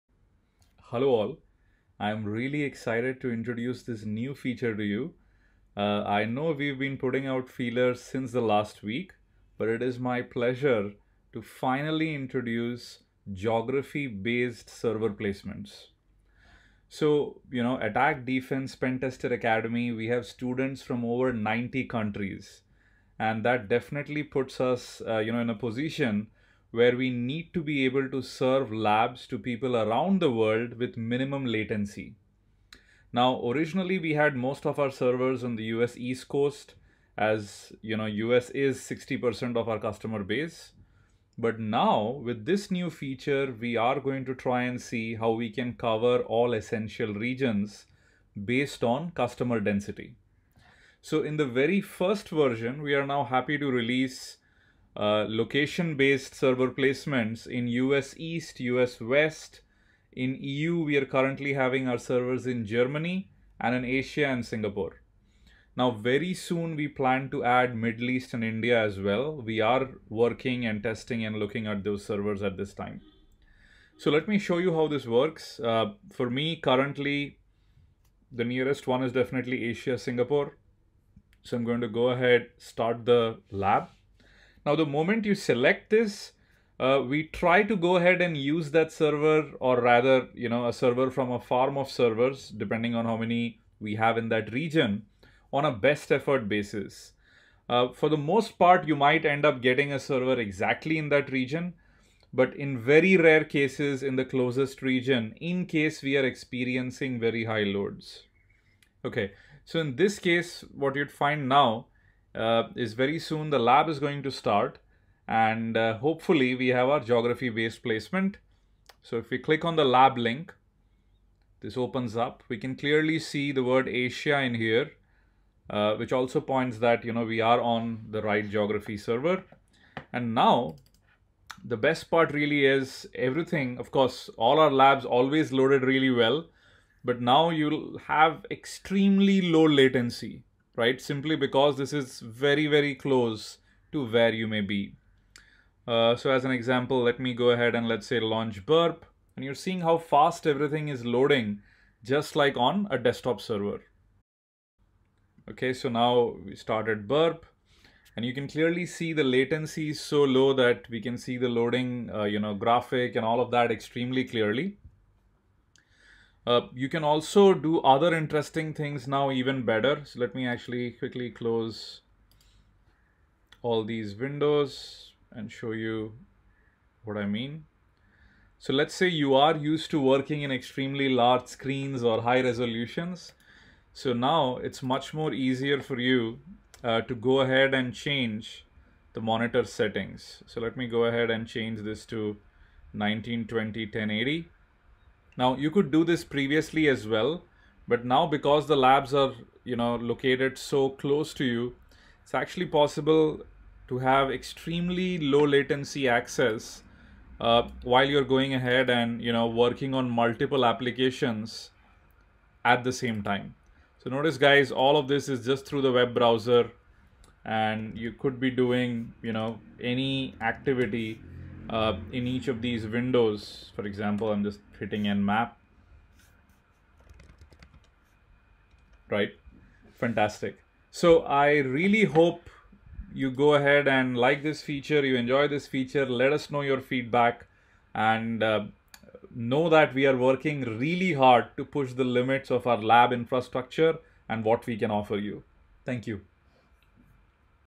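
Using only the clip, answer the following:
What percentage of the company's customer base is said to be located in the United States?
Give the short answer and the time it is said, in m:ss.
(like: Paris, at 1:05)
60%, at 0:38.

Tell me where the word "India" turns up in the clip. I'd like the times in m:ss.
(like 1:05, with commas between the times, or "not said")
1:08.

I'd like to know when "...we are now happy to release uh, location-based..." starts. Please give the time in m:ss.
0:52.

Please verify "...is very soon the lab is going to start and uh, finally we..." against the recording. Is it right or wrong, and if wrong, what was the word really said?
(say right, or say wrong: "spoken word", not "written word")
wrong: "hopefully", not "finally".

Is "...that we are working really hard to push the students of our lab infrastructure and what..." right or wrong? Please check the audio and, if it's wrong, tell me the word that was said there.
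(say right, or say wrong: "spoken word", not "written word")
wrong: "limits", not "students".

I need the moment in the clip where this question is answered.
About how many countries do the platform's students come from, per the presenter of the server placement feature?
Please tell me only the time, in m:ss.
0:21.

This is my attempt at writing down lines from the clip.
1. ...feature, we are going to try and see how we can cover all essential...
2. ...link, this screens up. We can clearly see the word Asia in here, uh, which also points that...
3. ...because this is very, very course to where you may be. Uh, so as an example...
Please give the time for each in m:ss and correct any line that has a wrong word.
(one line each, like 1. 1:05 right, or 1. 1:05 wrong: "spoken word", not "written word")
1. 0:42 right
2. 2:00 wrong: "opens", not "screens"
3. 2:21 wrong: "close", not "course".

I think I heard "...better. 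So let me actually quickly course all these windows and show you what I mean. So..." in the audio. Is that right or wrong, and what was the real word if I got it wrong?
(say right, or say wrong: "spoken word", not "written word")
wrong: "close", not "course".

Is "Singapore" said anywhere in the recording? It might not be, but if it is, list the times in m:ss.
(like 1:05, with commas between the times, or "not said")
1:04, 1:19.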